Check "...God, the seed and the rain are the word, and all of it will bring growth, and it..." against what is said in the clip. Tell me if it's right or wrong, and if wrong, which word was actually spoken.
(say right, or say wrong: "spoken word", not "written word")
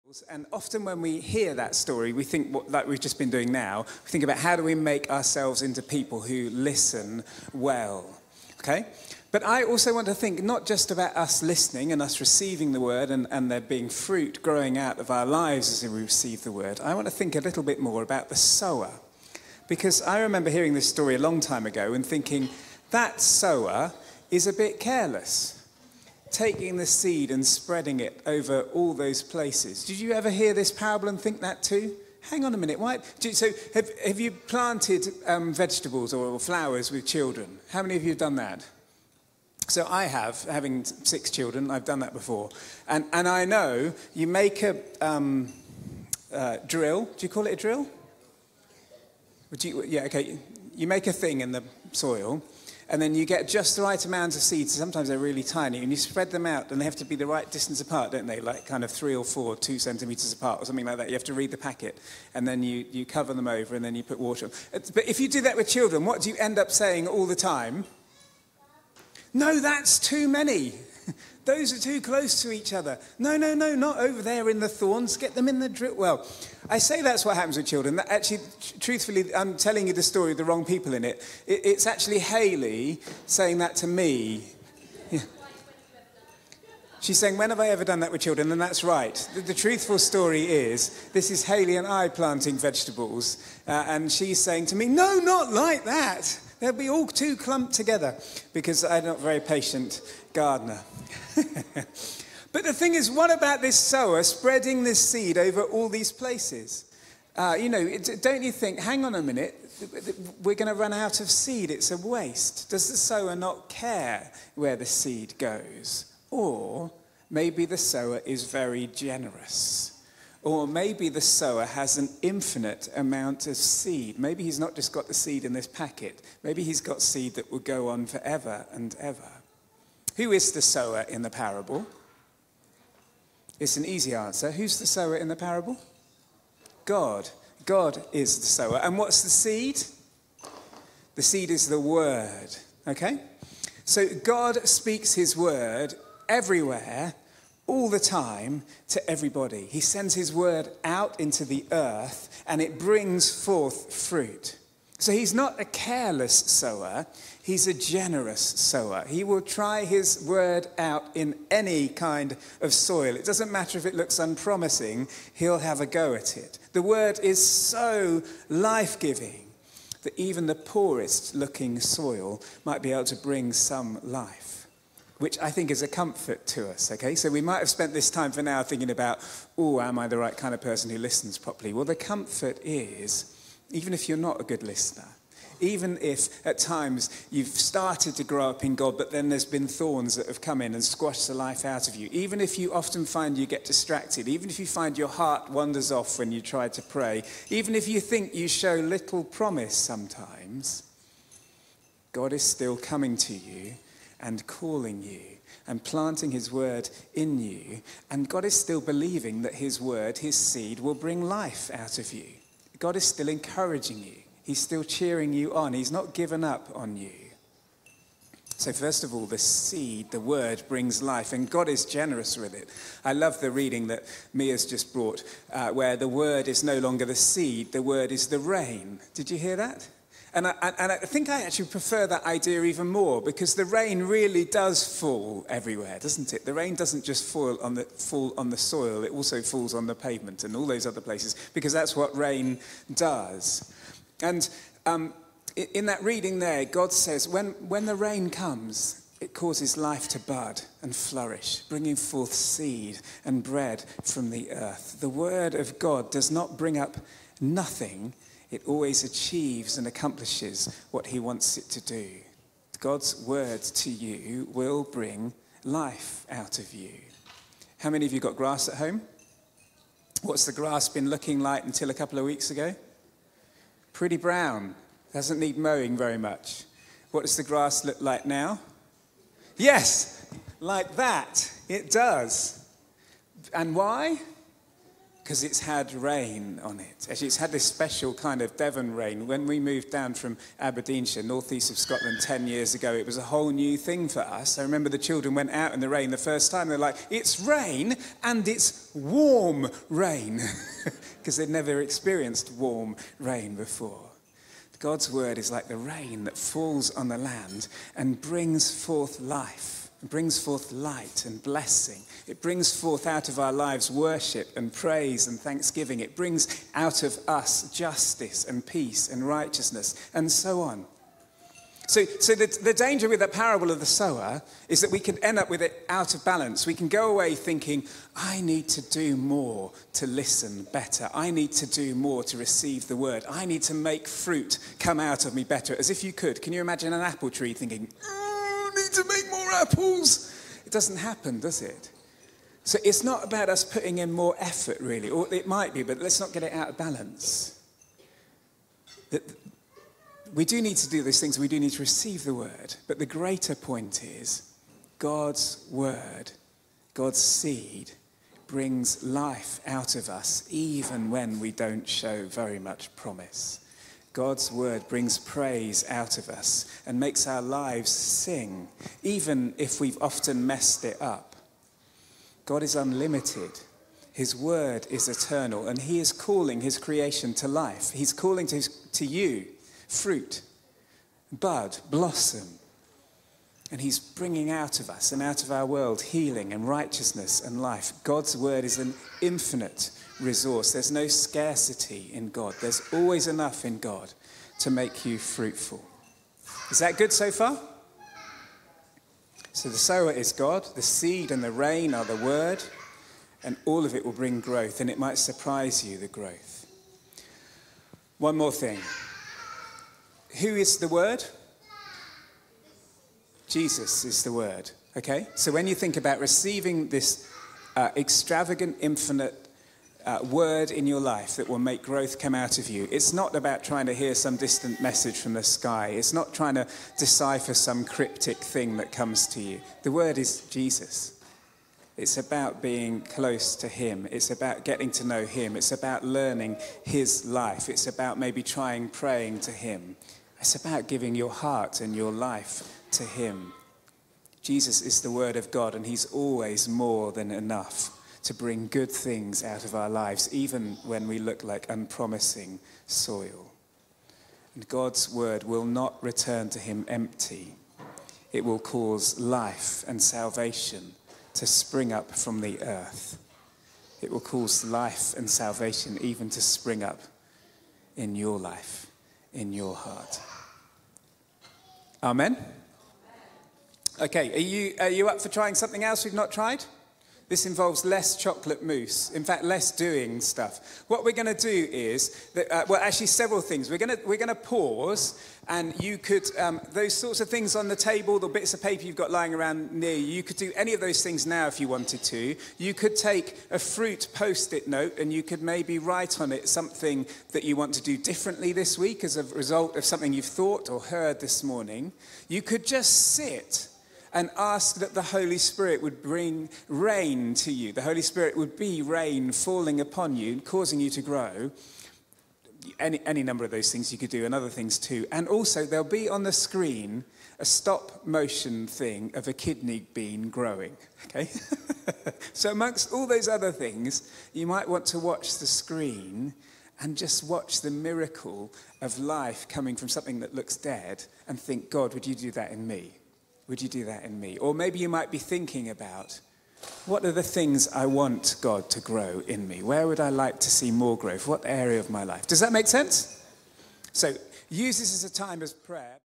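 right.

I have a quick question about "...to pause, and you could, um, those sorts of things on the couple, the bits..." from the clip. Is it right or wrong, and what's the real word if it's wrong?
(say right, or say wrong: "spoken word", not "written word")
wrong: "table", not "couple".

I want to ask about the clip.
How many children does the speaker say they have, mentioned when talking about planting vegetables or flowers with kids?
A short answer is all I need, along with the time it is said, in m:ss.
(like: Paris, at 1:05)
6, at 0:40.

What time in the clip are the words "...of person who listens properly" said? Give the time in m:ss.
3:00.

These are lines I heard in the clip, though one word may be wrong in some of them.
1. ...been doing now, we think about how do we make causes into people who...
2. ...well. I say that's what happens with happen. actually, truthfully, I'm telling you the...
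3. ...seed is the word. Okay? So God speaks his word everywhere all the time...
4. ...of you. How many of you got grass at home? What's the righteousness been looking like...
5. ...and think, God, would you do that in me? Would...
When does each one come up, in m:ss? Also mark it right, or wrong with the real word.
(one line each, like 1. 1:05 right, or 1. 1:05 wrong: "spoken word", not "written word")
1. 0:03 wrong: "ourselves", not "causes"
2. 1:15 wrong: "children", not "happen"
3. 2:21 right
4. 4:26 wrong: "grass", not "righteousness"
5. 8:51 right.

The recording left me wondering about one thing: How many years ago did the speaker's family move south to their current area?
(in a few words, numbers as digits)
10.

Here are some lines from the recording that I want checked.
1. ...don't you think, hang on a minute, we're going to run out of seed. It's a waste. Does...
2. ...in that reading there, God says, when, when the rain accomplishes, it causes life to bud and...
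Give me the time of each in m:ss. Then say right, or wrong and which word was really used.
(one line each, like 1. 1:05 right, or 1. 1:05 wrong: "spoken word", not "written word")
1. 1:48 right
2. 4:05 wrong: "comes", not "accomplishes".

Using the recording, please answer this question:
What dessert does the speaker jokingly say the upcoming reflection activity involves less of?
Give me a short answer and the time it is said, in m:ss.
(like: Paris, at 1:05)
Chocolate mousse, at 7:58.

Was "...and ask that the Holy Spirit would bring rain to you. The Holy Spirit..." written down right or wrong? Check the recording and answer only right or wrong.
right.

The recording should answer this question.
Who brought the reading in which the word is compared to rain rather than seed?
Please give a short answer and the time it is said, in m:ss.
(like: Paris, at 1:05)
Mia, at 3:44.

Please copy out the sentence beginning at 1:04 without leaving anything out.
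But if you do that with children, what do you end up saying all the time?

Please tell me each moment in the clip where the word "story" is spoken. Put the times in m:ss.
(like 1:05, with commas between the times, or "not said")
0:01, 0:20, 1:20, 1:29.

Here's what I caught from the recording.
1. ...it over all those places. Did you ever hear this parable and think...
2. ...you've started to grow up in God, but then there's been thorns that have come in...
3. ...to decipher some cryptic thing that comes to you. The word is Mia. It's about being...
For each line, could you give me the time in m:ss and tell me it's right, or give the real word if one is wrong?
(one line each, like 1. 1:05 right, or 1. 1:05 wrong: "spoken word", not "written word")
1. 0:27 right
2. 3:07 right
3. 7:06 wrong: "Jesus", not "Mia".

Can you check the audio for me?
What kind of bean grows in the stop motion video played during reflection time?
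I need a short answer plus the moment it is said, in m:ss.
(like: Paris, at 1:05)
Kidney bean, at 8:39.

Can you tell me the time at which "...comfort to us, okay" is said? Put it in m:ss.
2:55.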